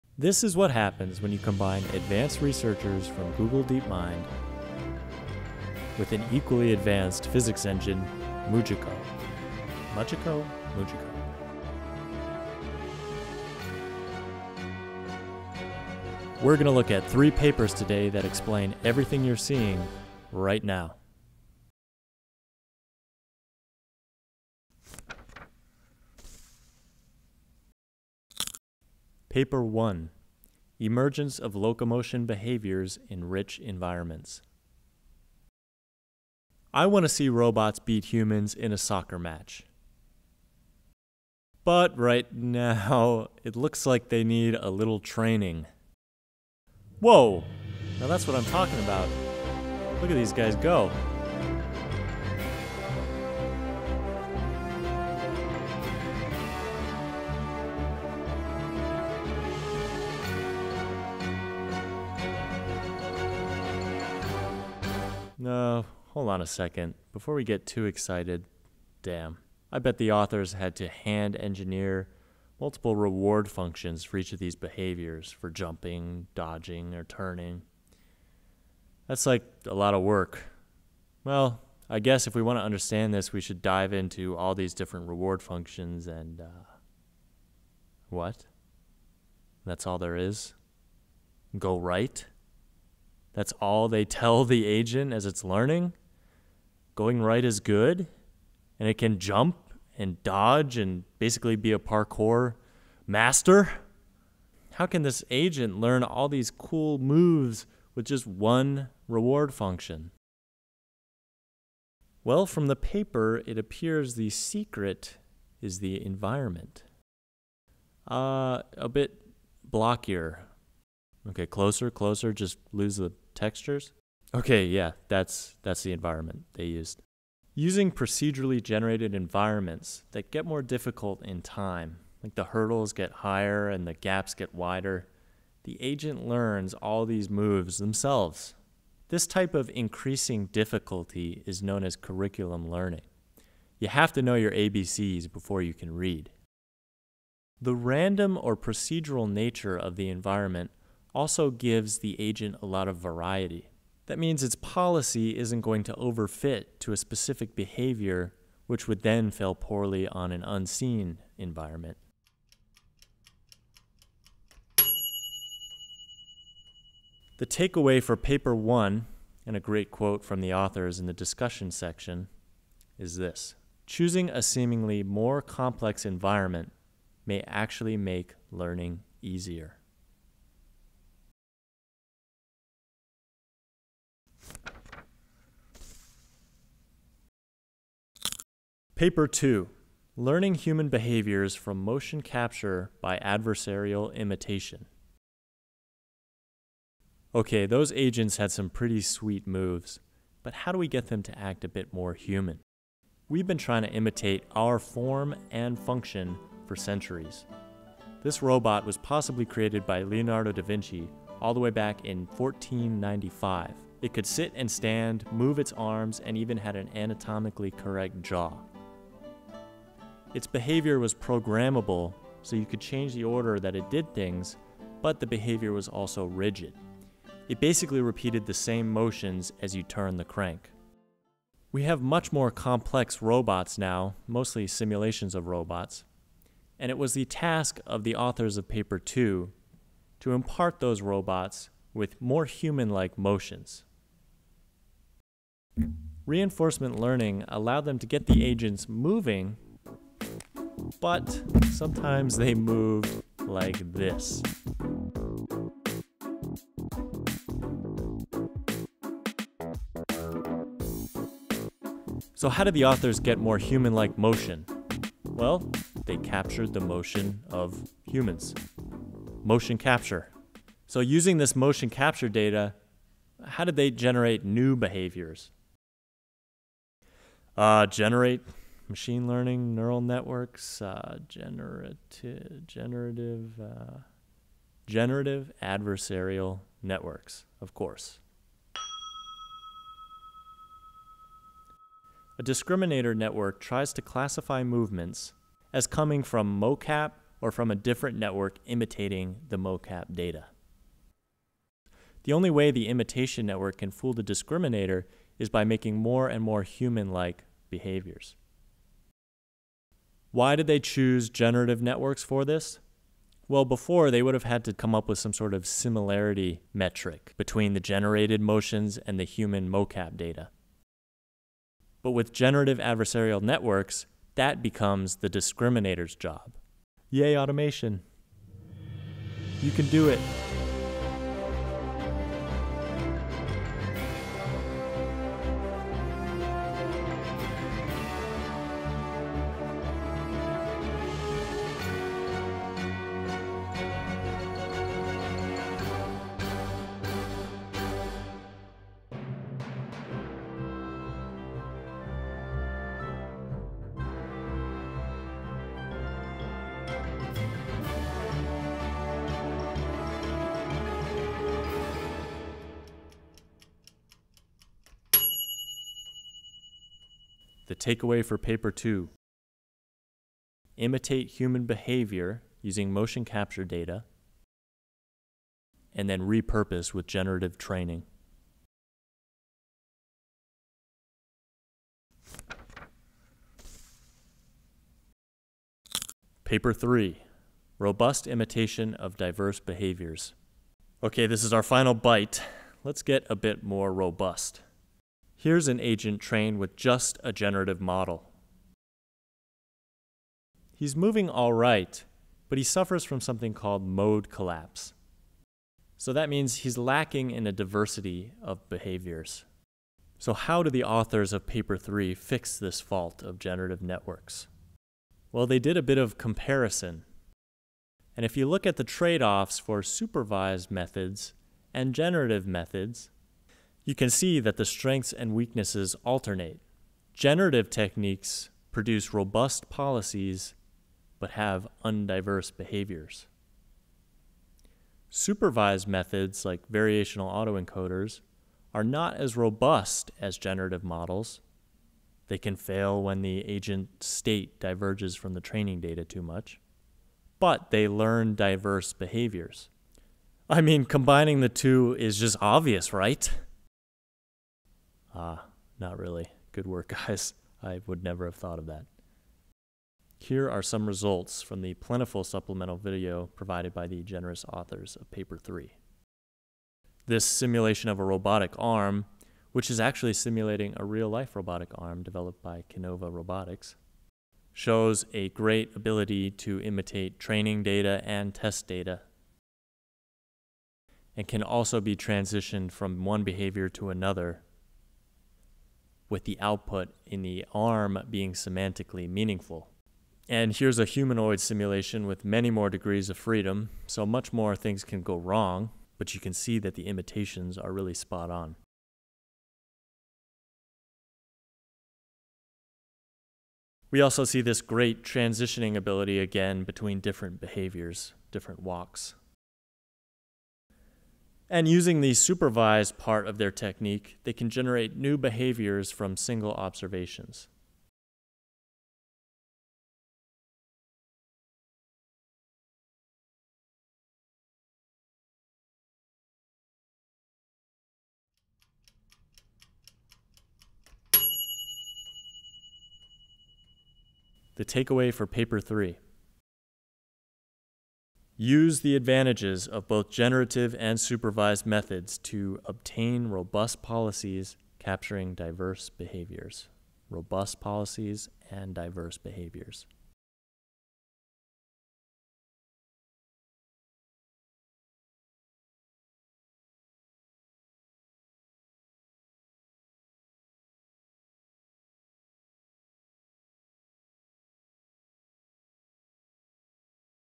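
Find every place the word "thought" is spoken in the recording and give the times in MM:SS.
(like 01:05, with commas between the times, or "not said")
07:38.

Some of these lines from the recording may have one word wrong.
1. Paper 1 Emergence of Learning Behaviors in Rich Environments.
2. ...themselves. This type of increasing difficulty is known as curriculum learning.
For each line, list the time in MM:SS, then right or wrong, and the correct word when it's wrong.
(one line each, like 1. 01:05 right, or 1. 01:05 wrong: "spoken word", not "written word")
1. 00:29 wrong: "Locomotion", not "Learning"
2. 02:17 right.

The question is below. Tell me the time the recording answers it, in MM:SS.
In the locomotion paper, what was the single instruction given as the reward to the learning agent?
01:31.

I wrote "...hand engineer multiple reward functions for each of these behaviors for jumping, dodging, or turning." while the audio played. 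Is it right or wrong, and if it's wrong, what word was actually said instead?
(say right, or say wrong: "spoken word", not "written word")
right.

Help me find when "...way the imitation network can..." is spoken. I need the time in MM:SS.
05:02.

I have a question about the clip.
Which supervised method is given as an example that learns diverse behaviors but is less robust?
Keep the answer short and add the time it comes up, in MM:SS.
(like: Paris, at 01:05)
Variational autoencoders, at 07:16.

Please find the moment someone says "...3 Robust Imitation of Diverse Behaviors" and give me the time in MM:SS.
06:26.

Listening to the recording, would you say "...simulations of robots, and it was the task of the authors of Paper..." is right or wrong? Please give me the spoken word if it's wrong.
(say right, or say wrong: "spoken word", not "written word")
right.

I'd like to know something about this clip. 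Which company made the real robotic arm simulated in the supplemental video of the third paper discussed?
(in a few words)
Kinova Robotics.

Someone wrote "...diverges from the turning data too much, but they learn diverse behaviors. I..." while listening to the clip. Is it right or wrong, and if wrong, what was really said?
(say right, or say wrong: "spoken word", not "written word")
wrong: "training", not "turning".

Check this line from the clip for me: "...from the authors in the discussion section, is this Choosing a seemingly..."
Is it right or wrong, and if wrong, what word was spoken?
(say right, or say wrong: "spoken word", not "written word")
right.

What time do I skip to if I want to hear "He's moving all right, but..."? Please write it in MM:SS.
06:40.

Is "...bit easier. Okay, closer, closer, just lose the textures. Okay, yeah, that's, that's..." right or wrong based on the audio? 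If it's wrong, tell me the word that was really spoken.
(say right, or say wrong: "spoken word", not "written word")
wrong: "blockier", not "easier".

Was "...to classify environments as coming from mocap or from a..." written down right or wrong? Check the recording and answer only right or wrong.
wrong.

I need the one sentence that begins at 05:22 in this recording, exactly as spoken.
But with generative adversarial networks, that becomes the discriminator's job.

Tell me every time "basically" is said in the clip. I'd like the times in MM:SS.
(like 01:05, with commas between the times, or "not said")
01:41, 03:47.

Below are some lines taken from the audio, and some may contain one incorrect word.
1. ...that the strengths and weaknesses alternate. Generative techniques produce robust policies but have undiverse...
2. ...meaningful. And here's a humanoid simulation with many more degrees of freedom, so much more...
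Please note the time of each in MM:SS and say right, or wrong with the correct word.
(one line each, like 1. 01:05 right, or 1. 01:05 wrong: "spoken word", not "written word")
1. 07:04 right
2. 08:09 right.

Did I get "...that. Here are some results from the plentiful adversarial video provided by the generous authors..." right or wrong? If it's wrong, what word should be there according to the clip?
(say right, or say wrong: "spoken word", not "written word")
wrong: "supplemental", not "adversarial".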